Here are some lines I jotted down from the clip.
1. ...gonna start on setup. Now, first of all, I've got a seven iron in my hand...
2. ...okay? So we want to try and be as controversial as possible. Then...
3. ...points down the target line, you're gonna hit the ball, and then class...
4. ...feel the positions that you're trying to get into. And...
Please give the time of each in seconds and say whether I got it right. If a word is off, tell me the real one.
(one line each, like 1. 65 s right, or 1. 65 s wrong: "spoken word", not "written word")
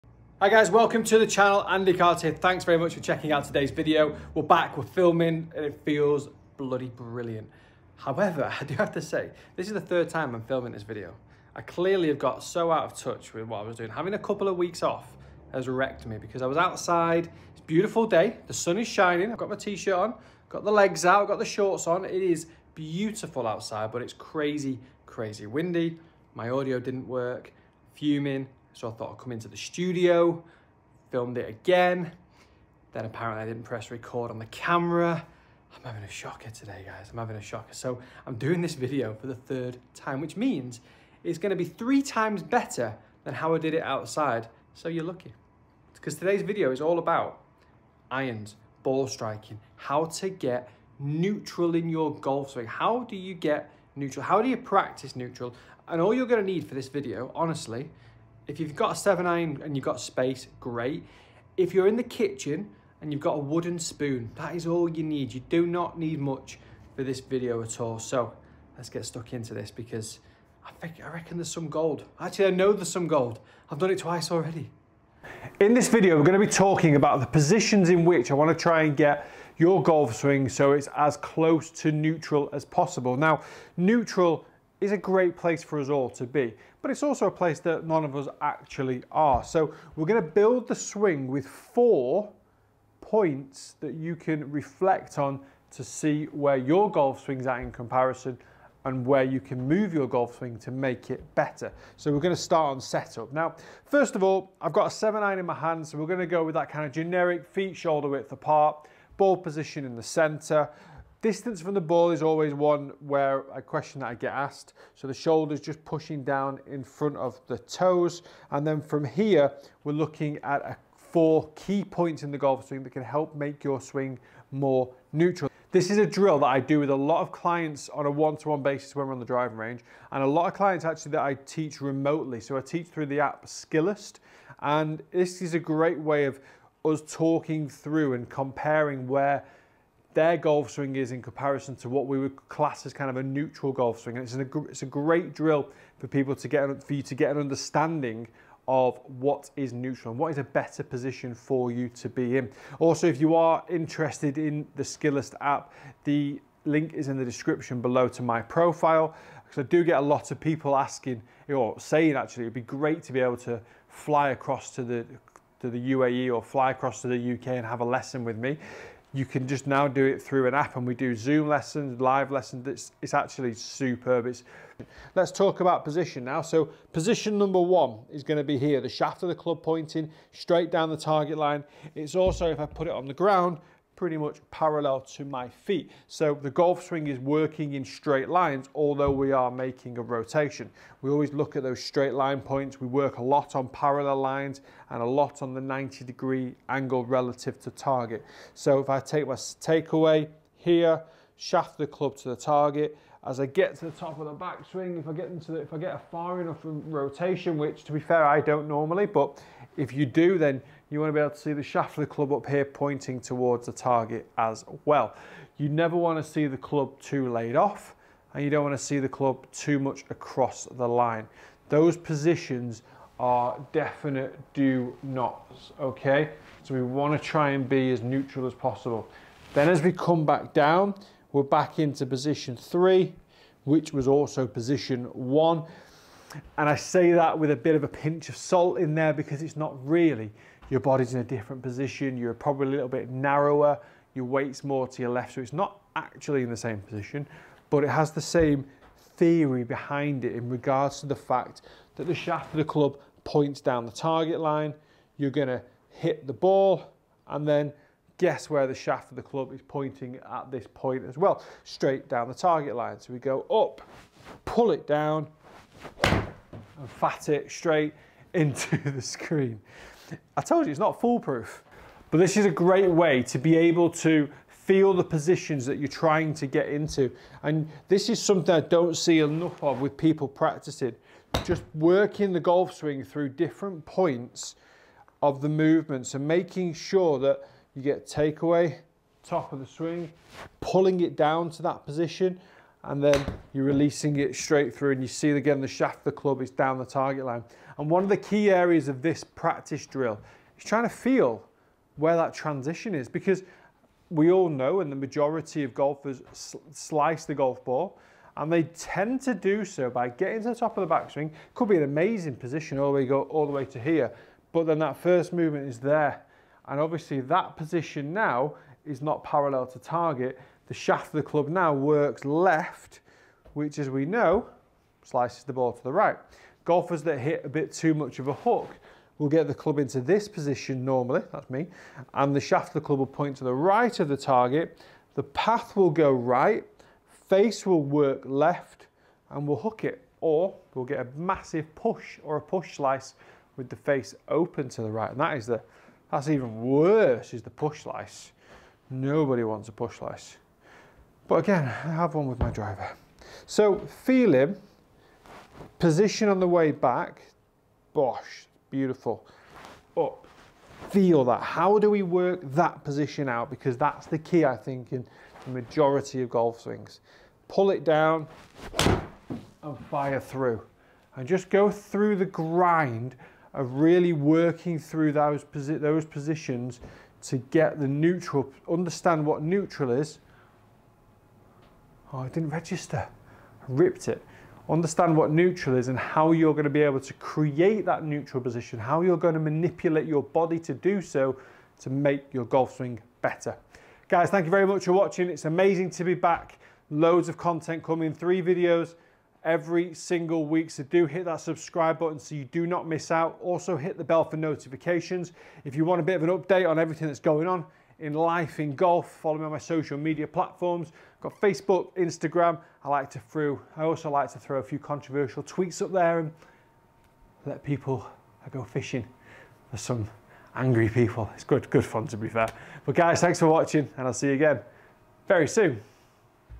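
1. 102 s right
2. 225 s wrong: "neutral", not "controversial"
3. 253 s wrong: "guess", not "class"
4. 274 s right.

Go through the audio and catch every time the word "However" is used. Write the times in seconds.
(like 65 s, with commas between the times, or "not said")
7 s.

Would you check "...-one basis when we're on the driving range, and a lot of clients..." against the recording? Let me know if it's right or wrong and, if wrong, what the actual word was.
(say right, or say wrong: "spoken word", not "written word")
right.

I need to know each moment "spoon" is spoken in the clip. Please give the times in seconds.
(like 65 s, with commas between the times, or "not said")
63 s.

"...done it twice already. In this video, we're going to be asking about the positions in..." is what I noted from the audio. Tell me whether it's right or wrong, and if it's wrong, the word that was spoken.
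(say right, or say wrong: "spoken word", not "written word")
wrong: "talking", not "asking".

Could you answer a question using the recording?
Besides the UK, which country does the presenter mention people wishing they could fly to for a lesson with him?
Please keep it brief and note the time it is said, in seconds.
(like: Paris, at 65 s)
UAE, at 165 s.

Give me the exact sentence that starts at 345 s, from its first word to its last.
And that is the, that's even worse, is the push slice.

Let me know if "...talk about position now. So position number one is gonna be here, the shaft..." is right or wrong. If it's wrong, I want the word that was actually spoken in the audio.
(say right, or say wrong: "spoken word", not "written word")
right.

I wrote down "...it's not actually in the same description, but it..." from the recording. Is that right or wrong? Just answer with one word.
wrong.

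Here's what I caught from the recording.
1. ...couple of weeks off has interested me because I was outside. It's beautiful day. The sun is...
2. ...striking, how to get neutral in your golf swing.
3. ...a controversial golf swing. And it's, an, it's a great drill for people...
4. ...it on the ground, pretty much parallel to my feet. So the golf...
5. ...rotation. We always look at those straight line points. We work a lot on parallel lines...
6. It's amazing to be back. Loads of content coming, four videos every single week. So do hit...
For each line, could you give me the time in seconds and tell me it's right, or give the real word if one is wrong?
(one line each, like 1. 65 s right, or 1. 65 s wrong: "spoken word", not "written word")
1. 14 s wrong: "wrecked", not "interested"
2. 49 s right
3. 143 s wrong: "neutral", not "controversial"
4. 182 s right
5. 190 s right
6. 395 s wrong: "three", not "four".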